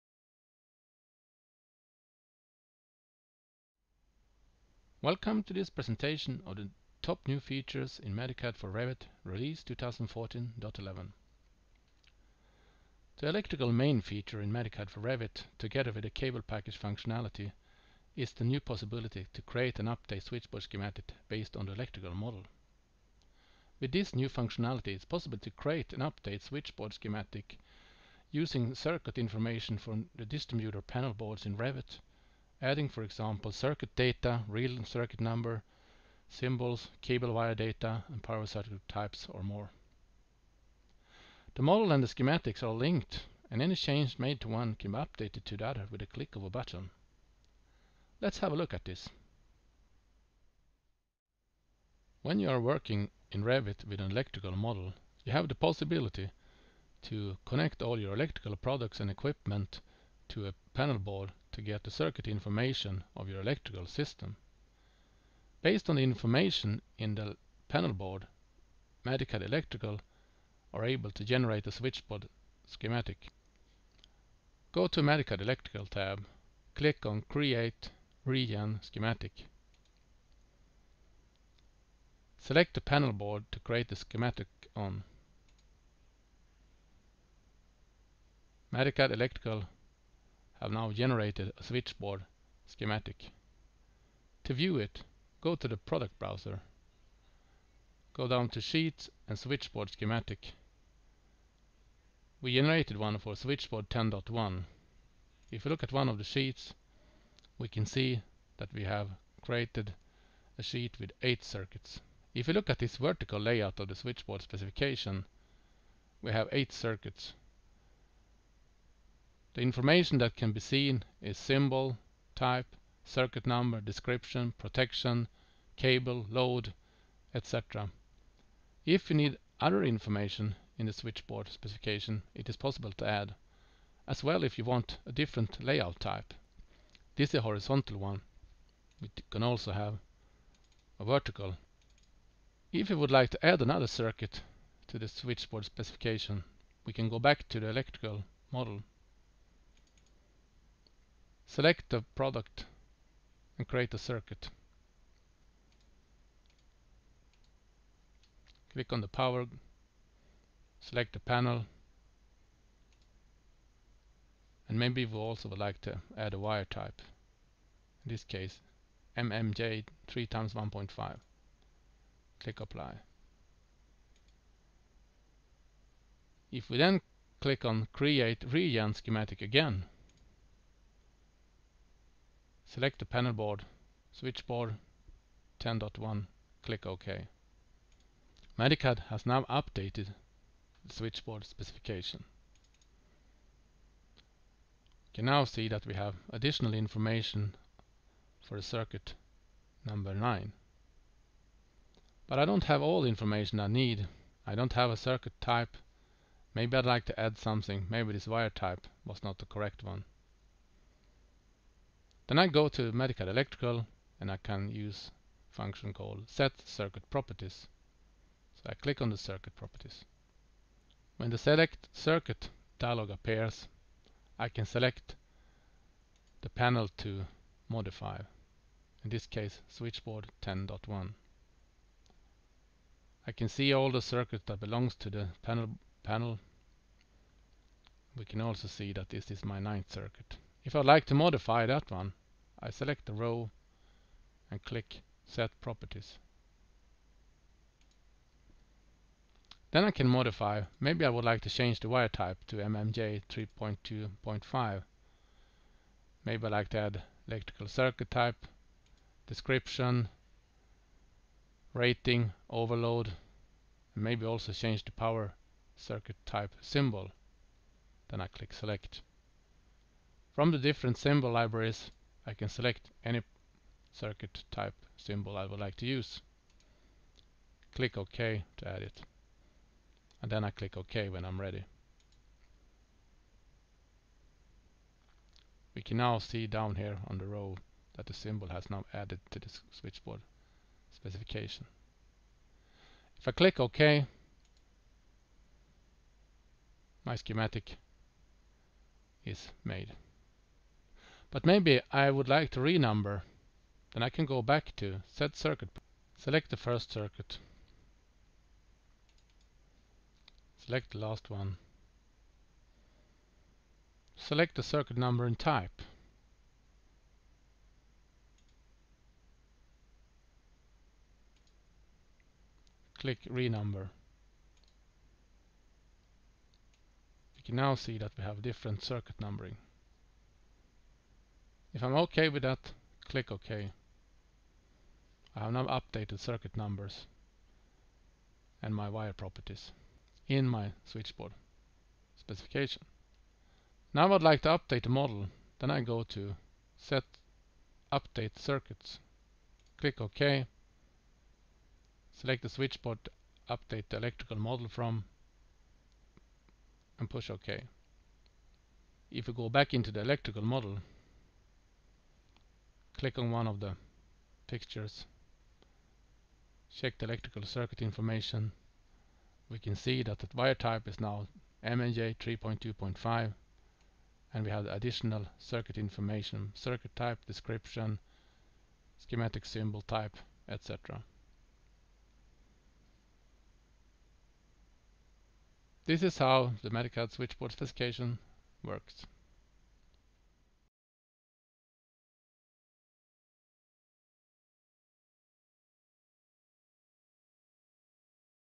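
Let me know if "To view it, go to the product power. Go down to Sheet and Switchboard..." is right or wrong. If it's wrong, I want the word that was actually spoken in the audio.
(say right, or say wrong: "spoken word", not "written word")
wrong: "browser", not "power".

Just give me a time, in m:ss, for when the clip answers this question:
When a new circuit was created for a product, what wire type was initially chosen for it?
2:49.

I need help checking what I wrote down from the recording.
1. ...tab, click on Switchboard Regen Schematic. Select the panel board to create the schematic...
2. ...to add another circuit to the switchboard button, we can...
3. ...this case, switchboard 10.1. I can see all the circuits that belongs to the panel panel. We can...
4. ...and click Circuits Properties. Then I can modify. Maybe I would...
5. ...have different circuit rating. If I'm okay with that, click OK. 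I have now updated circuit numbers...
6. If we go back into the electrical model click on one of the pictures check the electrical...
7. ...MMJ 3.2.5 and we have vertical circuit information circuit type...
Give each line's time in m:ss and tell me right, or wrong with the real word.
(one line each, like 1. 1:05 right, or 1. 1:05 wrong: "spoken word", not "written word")
1. 1:15 wrong: "Create", not "Switchboard"
2. 2:23 wrong: "specification", not "button"
3. 3:49 right
4. 4:04 wrong: "Set", not "Circuits"
5. 5:28 wrong: "numbering", not "rating"
6. 5:59 right
7. 6:11 wrong: "additional", not "vertical".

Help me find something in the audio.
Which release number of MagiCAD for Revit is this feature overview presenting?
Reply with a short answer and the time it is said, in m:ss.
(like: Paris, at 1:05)
2014.11, at 0:09.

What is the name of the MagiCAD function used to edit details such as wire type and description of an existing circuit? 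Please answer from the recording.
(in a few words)
Set circuit properties.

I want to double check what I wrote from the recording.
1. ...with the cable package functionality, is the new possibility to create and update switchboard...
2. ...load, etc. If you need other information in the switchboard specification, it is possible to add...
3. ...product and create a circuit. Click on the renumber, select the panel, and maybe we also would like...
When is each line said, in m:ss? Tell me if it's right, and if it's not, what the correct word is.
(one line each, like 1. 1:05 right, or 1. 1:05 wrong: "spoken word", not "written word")
1. 0:15 right
2. 2:06 right
3. 2:32 wrong: "power", not "renumber".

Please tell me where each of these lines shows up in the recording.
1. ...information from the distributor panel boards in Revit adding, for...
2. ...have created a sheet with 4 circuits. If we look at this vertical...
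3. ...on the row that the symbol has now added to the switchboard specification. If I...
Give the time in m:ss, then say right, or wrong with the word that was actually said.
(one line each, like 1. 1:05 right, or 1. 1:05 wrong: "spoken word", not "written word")
1. 0:29 right
2. 1:48 wrong: "8", not "4"
3. 4:47 right.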